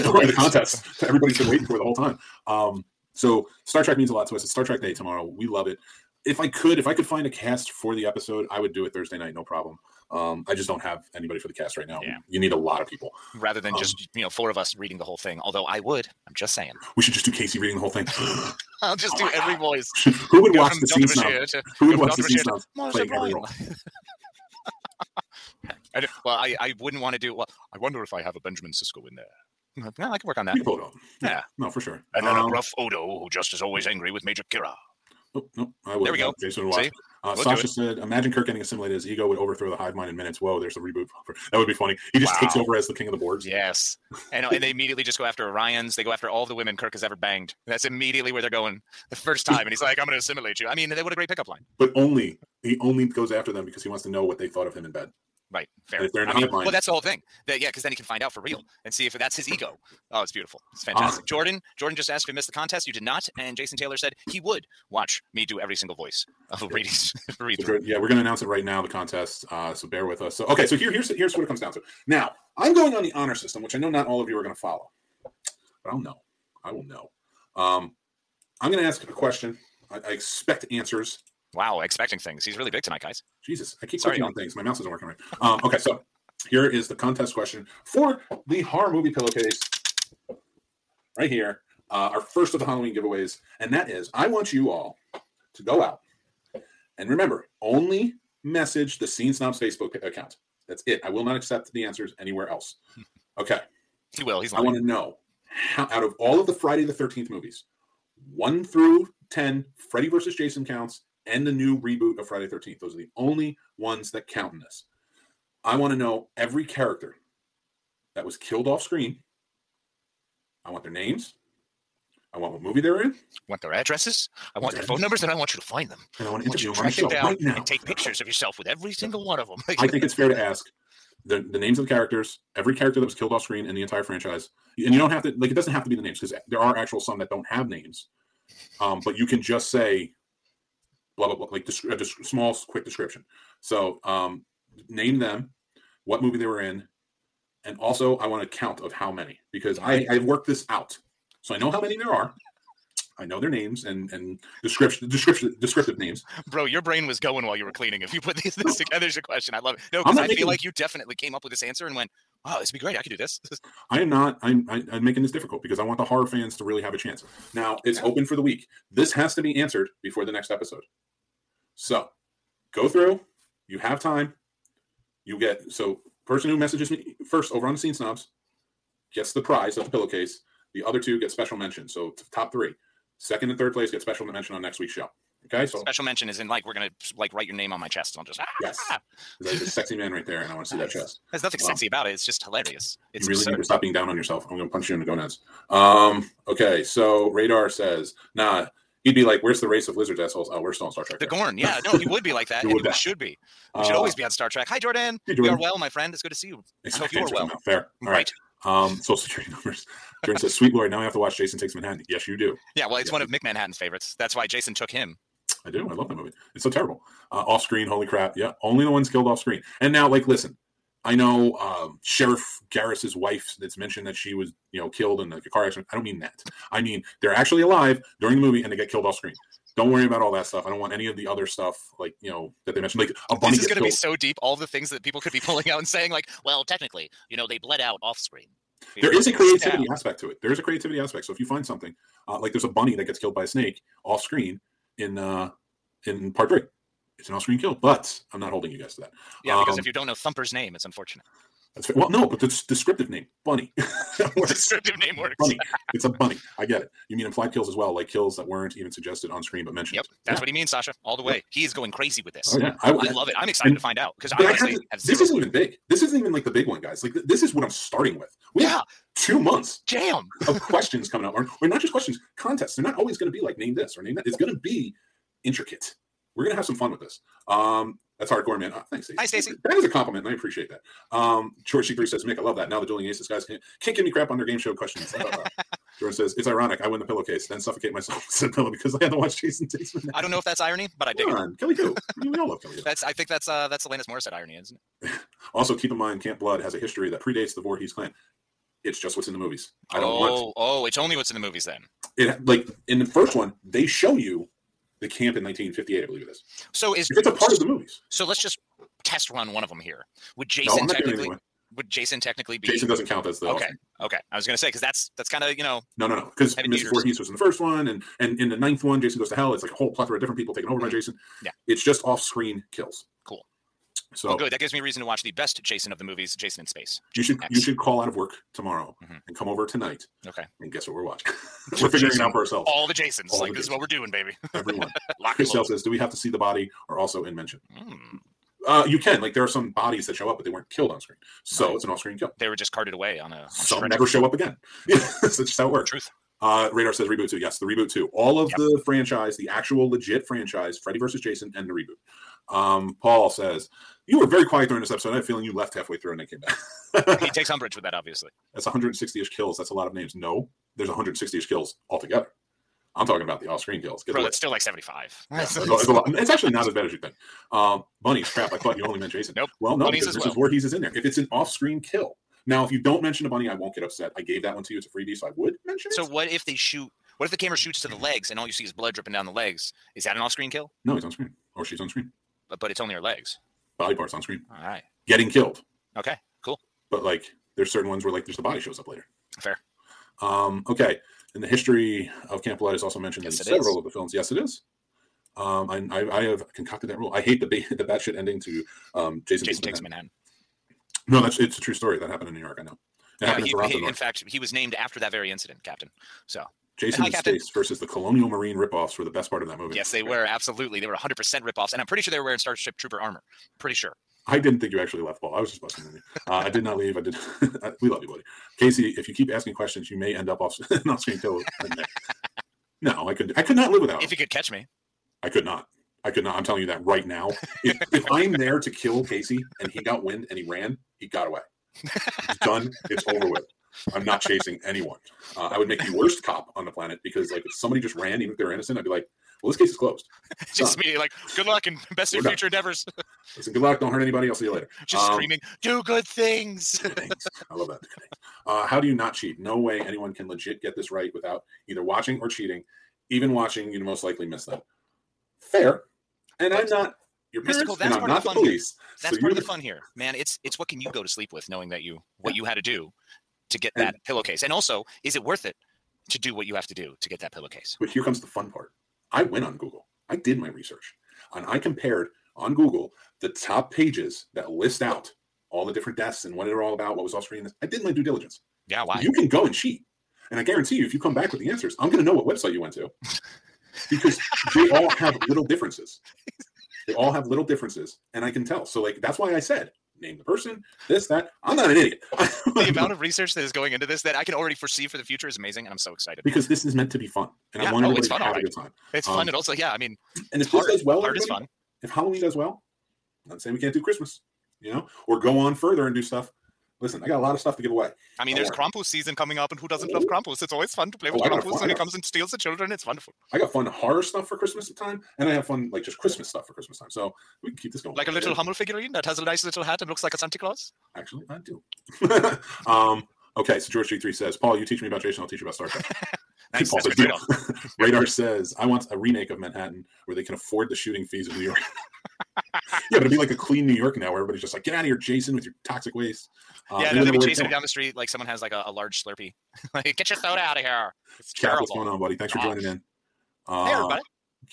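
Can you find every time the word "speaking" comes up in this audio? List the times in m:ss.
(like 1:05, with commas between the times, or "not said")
not said.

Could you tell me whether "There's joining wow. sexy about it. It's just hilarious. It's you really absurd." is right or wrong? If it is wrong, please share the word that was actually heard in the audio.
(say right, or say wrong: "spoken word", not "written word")
wrong: "nothing", not "joining".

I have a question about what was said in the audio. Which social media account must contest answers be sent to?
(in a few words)
Scene Snobs Facebook.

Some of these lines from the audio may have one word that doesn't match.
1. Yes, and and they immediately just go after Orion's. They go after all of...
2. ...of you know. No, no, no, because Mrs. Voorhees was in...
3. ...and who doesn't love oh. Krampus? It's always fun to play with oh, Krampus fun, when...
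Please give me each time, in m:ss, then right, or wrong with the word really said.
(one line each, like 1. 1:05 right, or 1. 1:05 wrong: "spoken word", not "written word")
1. 0:43 right
2. 5:15 right
3. 8:29 right.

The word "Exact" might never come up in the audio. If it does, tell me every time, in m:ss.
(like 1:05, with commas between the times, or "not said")
3:26.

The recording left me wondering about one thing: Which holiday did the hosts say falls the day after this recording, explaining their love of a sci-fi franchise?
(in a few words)
Star Trek Day.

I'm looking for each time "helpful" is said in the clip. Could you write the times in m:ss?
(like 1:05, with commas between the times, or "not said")
not said.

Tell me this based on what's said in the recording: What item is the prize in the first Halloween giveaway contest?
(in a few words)
Horror movie pillowcase.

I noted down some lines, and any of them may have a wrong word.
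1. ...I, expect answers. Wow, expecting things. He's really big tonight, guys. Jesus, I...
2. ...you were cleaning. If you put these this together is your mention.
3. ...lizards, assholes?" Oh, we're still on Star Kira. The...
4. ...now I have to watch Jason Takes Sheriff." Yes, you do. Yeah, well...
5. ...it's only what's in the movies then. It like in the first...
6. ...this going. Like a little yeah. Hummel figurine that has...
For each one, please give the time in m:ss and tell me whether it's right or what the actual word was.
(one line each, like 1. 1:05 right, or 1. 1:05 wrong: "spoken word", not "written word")
1. 1:20 right
2. 2:37 wrong: "question", not "mention"
3. 3:19 wrong: "Trek", not "Kira"
4. 3:30 wrong: "Manhattan", not "Sheriff"
5. 5:00 right
6. 8:37 right.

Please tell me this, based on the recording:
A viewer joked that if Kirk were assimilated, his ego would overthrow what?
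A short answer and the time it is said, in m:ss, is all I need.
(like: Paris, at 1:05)
The hive mind, at 0:39.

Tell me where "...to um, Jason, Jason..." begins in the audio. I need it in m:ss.
6:38.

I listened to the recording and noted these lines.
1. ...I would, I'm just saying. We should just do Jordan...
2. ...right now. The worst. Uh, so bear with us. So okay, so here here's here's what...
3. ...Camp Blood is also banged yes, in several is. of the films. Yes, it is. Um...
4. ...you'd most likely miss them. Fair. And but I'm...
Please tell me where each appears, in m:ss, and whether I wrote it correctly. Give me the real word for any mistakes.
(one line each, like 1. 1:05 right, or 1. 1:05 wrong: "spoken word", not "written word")
1. 0:15 wrong: "Casey", not "Jordan"
2. 1:08 wrong: "contest", not "worst"
3. 6:32 wrong: "mentioned", not "banged"
4. 7:33 right.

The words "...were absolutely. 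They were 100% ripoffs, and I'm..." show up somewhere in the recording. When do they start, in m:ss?
6:50.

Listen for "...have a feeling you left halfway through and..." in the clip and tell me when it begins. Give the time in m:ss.
5:55.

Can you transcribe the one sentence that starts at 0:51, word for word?
But only he only goes after them because he wants to know what they thought of him in bed.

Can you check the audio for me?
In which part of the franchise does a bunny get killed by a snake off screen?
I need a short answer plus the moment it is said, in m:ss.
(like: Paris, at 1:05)
Part three, at 4:06.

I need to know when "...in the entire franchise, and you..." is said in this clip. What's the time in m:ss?
2:13.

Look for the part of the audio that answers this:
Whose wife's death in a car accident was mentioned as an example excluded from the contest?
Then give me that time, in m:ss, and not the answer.
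3:42.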